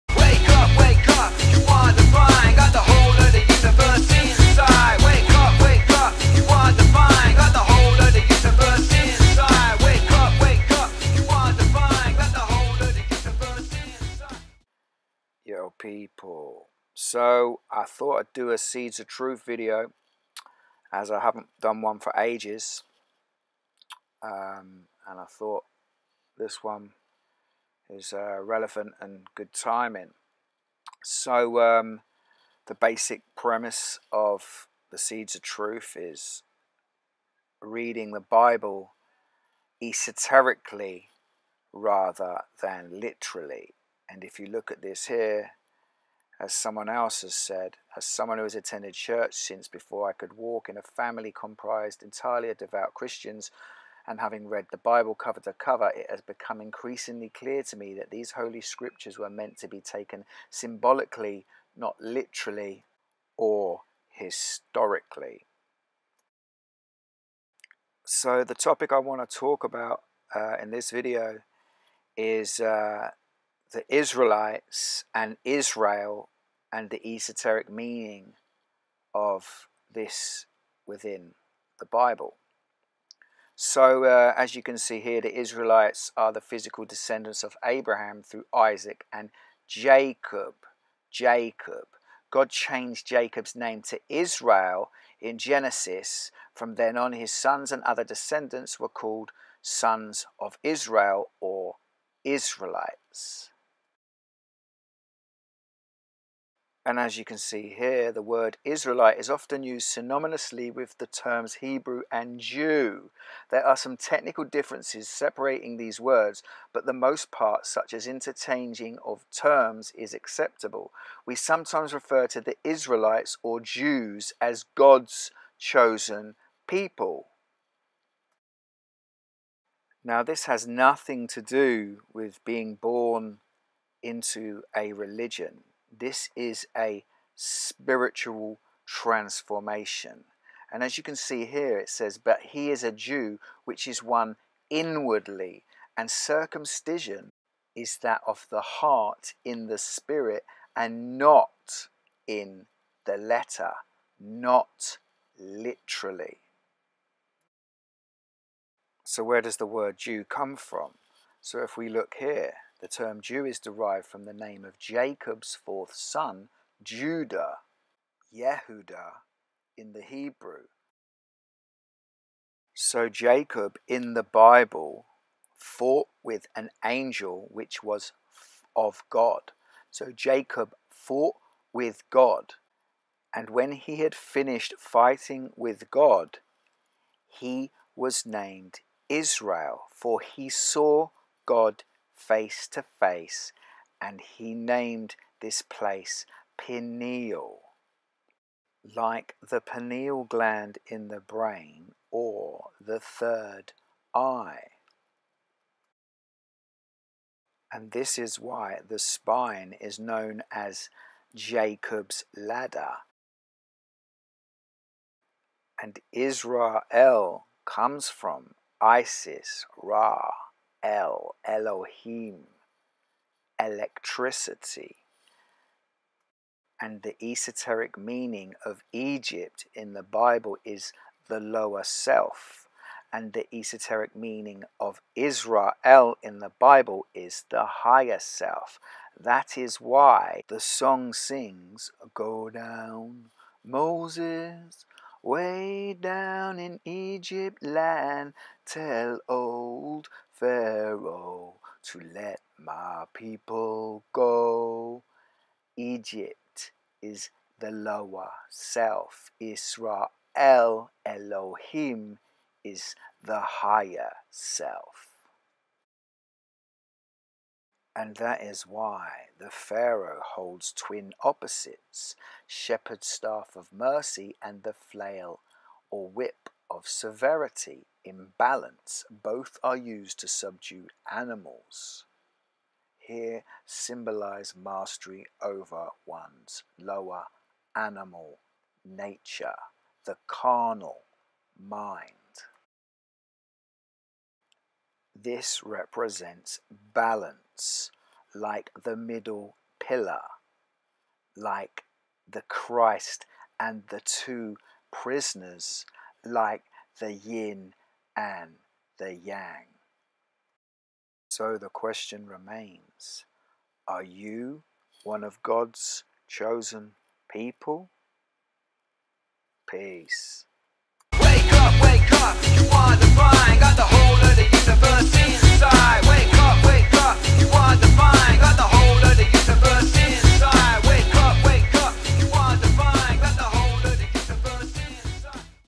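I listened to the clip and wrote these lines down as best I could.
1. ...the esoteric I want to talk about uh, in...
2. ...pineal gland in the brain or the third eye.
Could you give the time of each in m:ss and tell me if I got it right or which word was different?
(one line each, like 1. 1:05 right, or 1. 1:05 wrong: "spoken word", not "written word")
1. 1:08 wrong: "topic", not "esoteric"
2. 3:19 right.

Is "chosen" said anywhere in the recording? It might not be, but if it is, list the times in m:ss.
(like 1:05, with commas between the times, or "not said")
2:05, 5:16.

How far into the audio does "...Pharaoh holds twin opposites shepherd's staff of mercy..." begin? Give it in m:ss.
4:29.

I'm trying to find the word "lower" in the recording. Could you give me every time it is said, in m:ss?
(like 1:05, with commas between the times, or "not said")
3:51, 4:17, 4:46.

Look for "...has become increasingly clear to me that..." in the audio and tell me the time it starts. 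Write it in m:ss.
0:56.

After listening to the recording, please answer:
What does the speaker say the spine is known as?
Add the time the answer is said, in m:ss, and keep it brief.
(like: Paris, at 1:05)
Jacob's ladder, at 3:31.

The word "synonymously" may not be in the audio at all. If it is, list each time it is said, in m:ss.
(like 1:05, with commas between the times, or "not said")
1:49.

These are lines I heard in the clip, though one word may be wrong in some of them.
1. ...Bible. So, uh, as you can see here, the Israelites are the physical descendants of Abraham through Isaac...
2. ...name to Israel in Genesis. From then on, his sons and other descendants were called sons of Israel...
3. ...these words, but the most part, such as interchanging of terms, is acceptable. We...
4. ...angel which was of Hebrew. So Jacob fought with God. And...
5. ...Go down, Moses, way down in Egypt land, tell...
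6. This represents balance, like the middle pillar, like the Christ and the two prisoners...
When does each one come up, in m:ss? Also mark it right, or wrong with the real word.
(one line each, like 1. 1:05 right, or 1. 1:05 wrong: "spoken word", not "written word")
1. 1:21 right
2. 1:33 right
3. 1:55 right
4. 2:56 wrong: "God", not "Hebrew"
5. 4:02 right
6. 4:55 right.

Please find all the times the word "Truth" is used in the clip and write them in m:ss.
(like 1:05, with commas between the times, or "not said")
0:19, 0:35.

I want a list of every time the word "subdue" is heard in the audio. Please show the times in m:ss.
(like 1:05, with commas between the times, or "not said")
4:40.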